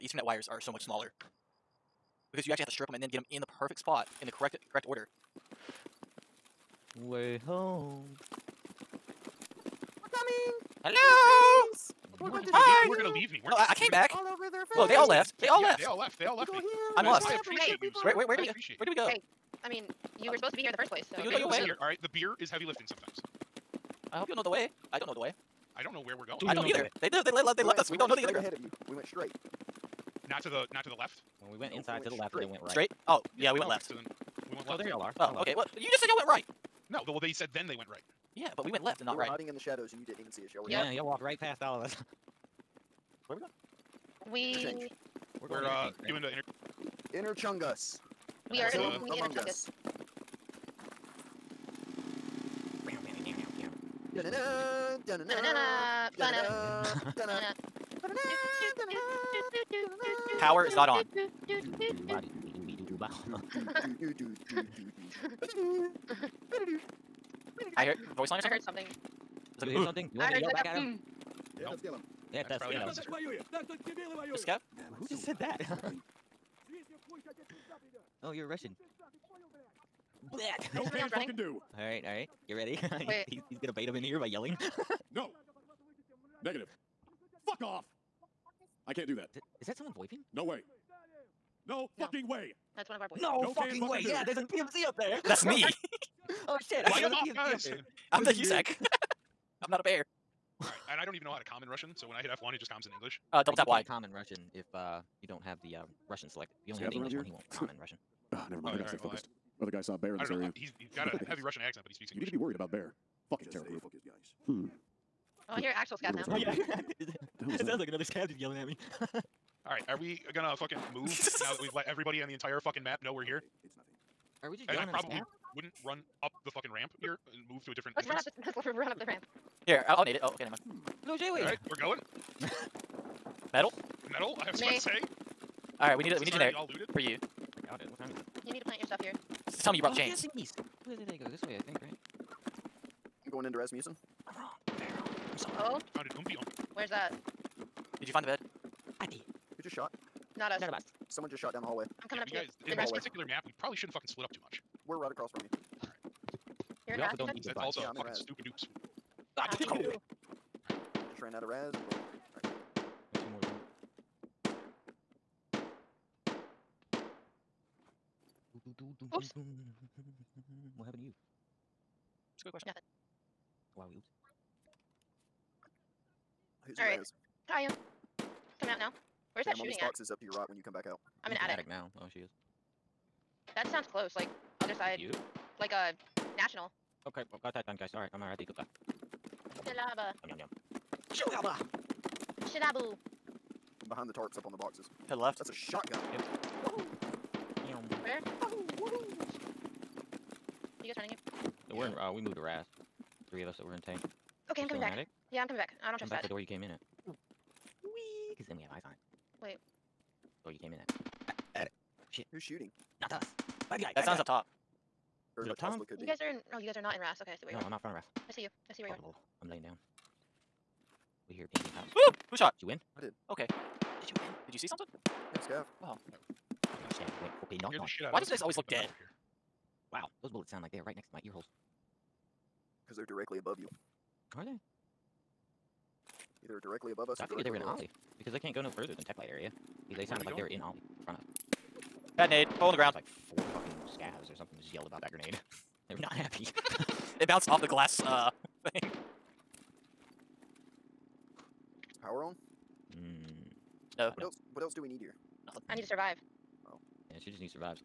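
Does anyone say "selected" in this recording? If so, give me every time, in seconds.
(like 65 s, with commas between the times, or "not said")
106 s.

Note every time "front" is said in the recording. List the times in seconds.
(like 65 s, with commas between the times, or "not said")
217 s, 241 s.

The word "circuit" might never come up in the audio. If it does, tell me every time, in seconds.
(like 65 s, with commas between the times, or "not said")
not said.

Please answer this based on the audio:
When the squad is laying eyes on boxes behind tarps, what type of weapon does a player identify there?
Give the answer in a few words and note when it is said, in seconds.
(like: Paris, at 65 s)
Shotgun, at 195 s.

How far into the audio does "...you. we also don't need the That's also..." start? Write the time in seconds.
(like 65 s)
155 s.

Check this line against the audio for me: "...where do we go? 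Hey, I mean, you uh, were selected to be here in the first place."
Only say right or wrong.
wrong.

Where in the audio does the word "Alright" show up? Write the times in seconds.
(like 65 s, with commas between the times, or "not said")
131 s, 135 s.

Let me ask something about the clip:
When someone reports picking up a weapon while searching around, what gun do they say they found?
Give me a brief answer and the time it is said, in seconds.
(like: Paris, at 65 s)
UMP, at 146 s.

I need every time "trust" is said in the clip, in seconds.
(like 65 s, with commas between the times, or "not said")
205 s.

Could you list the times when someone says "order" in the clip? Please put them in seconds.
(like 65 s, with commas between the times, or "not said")
4 s.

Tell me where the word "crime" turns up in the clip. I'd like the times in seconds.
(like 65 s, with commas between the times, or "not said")
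not said.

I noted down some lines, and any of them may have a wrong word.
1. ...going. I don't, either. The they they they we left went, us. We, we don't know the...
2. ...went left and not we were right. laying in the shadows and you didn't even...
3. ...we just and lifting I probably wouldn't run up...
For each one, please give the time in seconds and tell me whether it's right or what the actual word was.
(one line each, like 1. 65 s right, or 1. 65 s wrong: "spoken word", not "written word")
1. 26 s right
2. 38 s wrong: "hiding", not "laying"
3. 124 s wrong: "yelling", not "lifting".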